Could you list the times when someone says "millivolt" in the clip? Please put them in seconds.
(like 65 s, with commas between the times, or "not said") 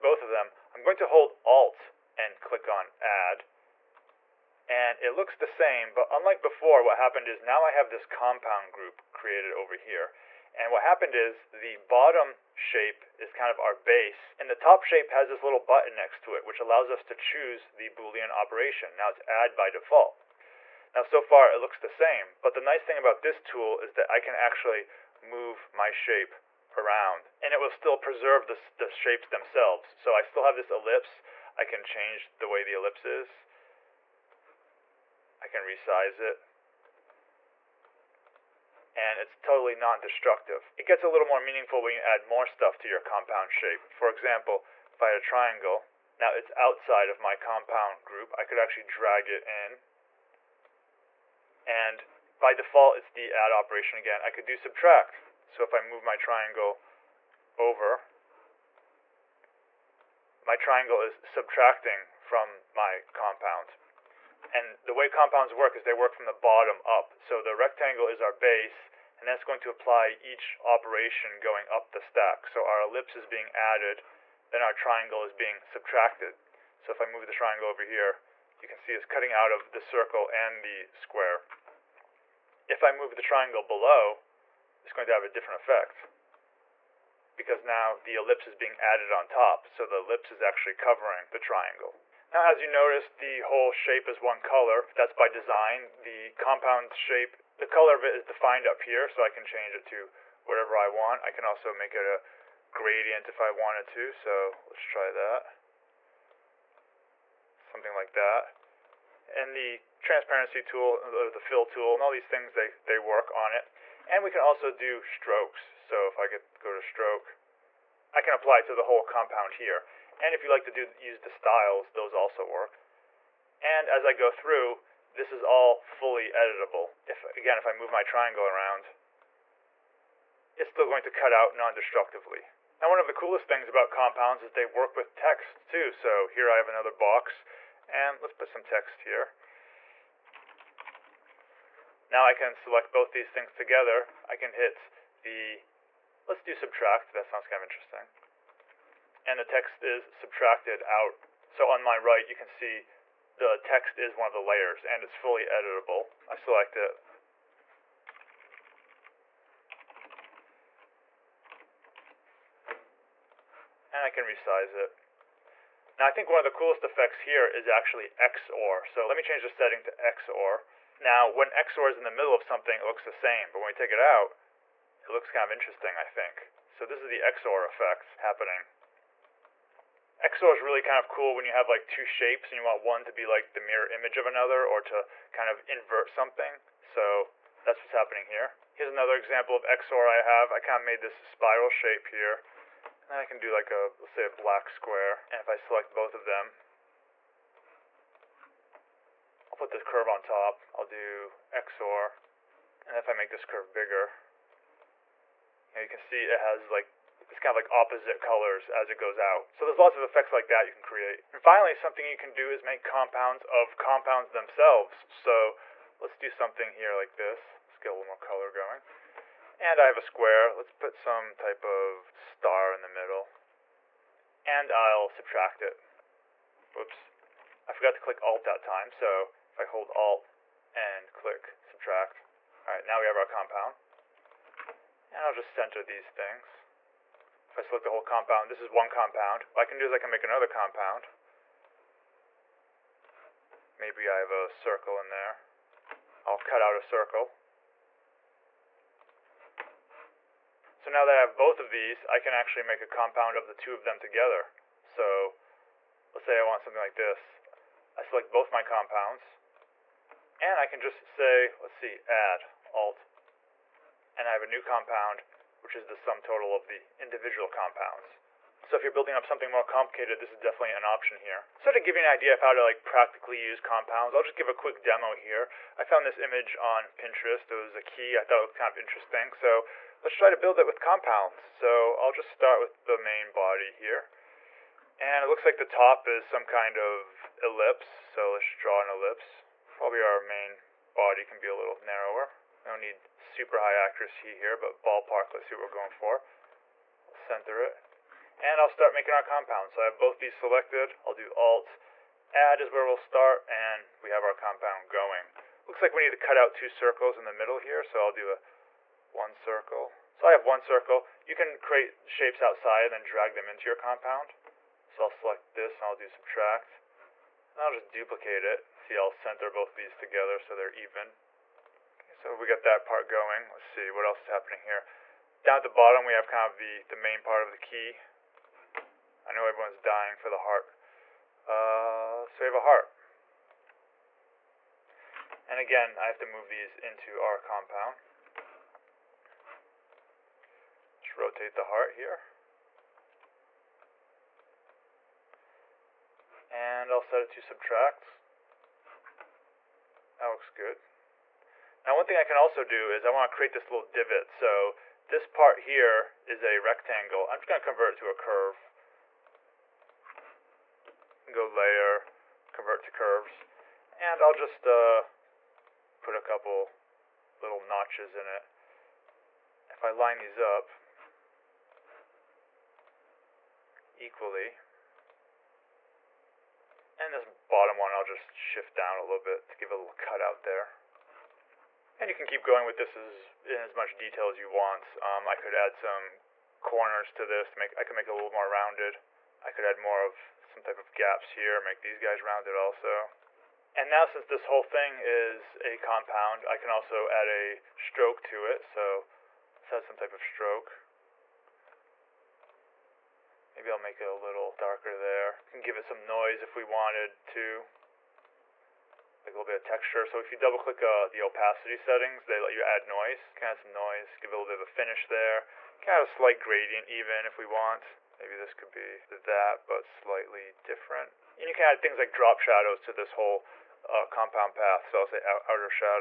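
not said.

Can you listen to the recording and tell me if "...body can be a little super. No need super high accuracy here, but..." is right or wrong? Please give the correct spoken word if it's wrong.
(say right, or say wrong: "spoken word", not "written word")
wrong: "narrower", not "super".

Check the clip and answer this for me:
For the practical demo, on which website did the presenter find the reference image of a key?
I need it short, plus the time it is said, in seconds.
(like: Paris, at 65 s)
Pinterest, at 276 s.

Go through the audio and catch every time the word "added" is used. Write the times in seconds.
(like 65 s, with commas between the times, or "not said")
73 s, 88 s.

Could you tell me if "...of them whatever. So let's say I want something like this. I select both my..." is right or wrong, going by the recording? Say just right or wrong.
wrong.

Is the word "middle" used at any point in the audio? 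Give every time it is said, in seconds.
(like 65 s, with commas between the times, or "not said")
172 s, 222 s, 307 s.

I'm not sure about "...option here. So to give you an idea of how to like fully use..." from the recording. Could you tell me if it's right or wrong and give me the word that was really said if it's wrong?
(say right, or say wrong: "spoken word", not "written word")
wrong: "practically", not "fully".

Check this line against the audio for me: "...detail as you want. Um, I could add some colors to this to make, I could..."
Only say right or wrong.
wrong.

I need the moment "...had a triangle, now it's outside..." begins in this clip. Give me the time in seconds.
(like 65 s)
45 s.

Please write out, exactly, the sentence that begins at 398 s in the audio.
So let's add some type of stroke.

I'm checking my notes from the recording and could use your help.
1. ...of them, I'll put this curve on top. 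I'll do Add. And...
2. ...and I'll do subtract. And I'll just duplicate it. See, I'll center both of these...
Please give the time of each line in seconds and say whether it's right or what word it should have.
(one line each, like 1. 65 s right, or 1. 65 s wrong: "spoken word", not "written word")
1. 196 s wrong: "XOR", not "Add"
2. 315 s right.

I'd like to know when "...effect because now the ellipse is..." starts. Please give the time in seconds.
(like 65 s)
85 s.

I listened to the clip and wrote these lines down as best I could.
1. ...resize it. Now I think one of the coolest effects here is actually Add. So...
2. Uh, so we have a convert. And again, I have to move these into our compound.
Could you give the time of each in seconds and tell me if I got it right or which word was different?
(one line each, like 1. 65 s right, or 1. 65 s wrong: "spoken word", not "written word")
1. 164 s wrong: "XOR", not "Add"
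2. 331 s wrong: "heart", not "convert".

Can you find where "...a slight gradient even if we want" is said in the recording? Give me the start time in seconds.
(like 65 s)
416 s.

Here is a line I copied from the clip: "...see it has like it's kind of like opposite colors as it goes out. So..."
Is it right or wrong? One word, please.
right.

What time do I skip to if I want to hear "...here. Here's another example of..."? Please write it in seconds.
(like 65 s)
188 s.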